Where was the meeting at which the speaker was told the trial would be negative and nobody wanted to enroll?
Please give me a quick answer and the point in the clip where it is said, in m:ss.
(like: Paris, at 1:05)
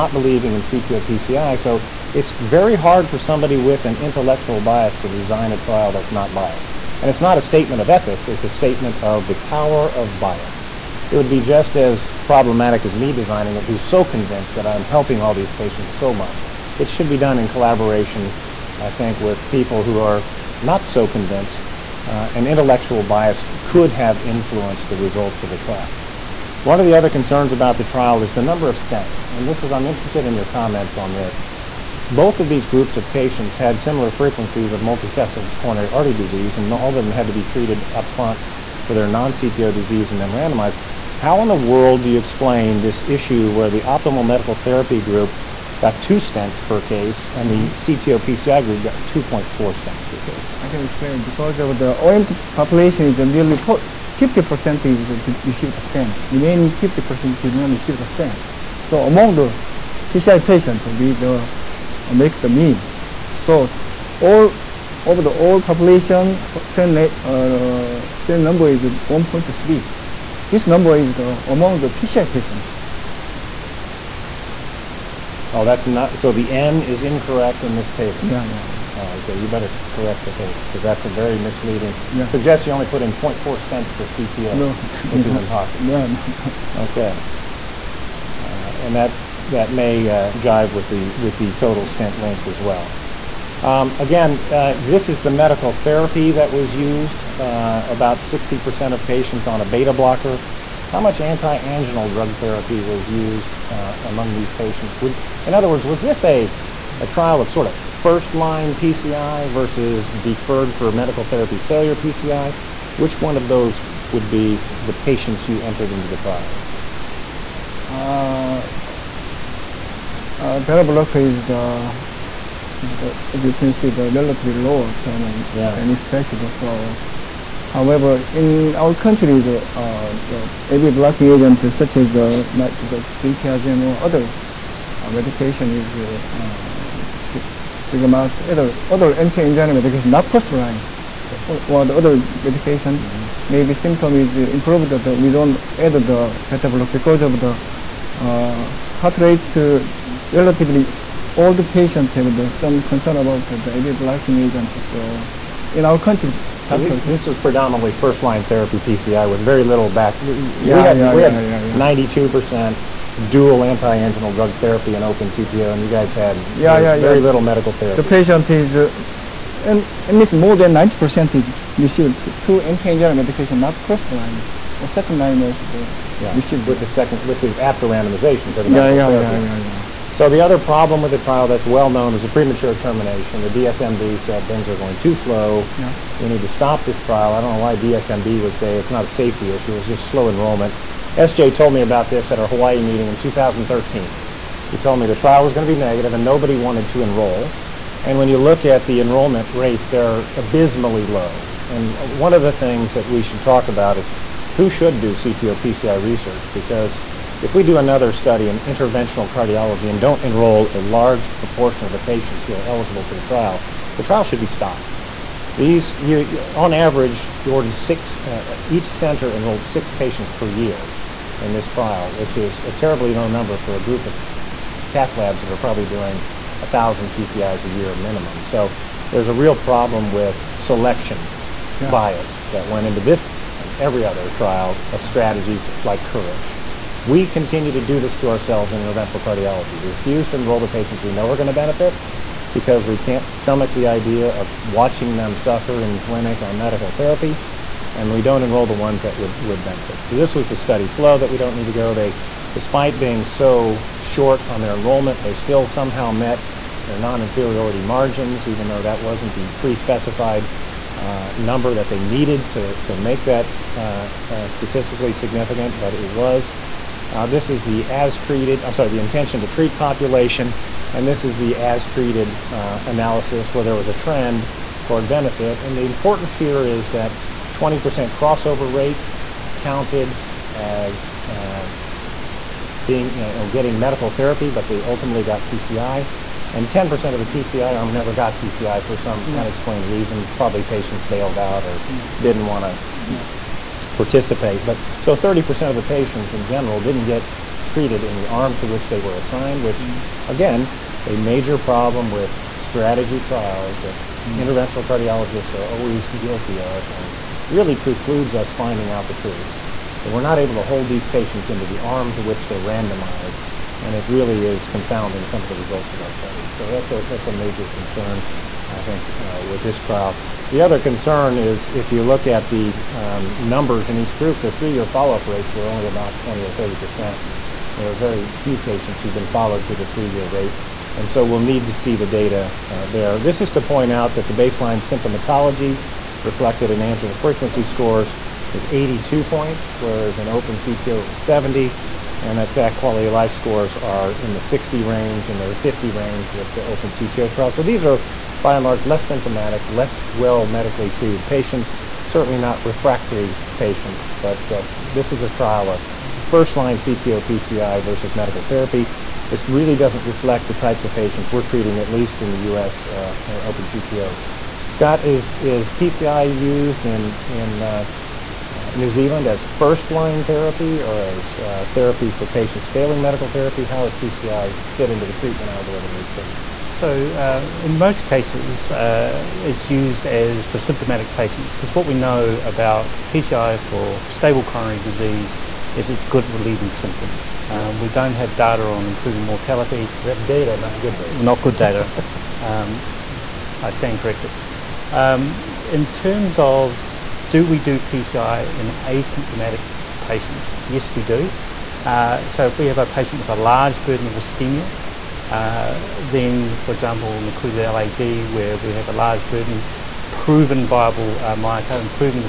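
Hawaii, at 3:12.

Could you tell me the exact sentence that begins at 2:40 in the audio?
Yeah, we had, 92% dual anti-anginal drug therapy and open CTO, and you guys had yeah, you yeah, very yeah.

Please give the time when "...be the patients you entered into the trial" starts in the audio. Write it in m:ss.
1:54.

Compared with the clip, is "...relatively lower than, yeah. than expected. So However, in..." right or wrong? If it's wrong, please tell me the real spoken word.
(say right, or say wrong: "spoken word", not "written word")
right.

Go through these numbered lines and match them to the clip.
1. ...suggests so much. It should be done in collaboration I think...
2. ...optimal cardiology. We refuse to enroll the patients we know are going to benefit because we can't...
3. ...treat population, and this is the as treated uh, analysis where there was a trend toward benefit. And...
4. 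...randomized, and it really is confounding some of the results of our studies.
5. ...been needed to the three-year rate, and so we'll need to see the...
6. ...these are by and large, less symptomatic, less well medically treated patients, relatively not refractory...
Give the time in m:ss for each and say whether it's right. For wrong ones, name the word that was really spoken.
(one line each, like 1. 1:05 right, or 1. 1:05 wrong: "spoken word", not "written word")
1. 0:15 wrong: "patients", not "suggests"
2. 3:58 wrong: "interventional", not "optimal"
3. 4:29 right
4. 5:12 right
5. 5:29 wrong: "followed", not "needed"
6. 5:47 wrong: "certainly", not "relatively".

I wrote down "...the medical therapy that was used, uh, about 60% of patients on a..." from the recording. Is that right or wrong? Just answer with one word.
right.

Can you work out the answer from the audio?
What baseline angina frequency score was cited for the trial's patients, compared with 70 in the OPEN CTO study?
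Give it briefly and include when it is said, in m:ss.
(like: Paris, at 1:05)
82, at 5:38.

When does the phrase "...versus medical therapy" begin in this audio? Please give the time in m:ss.
5:57.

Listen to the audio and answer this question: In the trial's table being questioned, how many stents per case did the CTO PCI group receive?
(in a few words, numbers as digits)
2.4.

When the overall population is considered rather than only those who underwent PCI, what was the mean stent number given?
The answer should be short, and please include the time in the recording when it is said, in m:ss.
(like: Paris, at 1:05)
1.3, at 1:08.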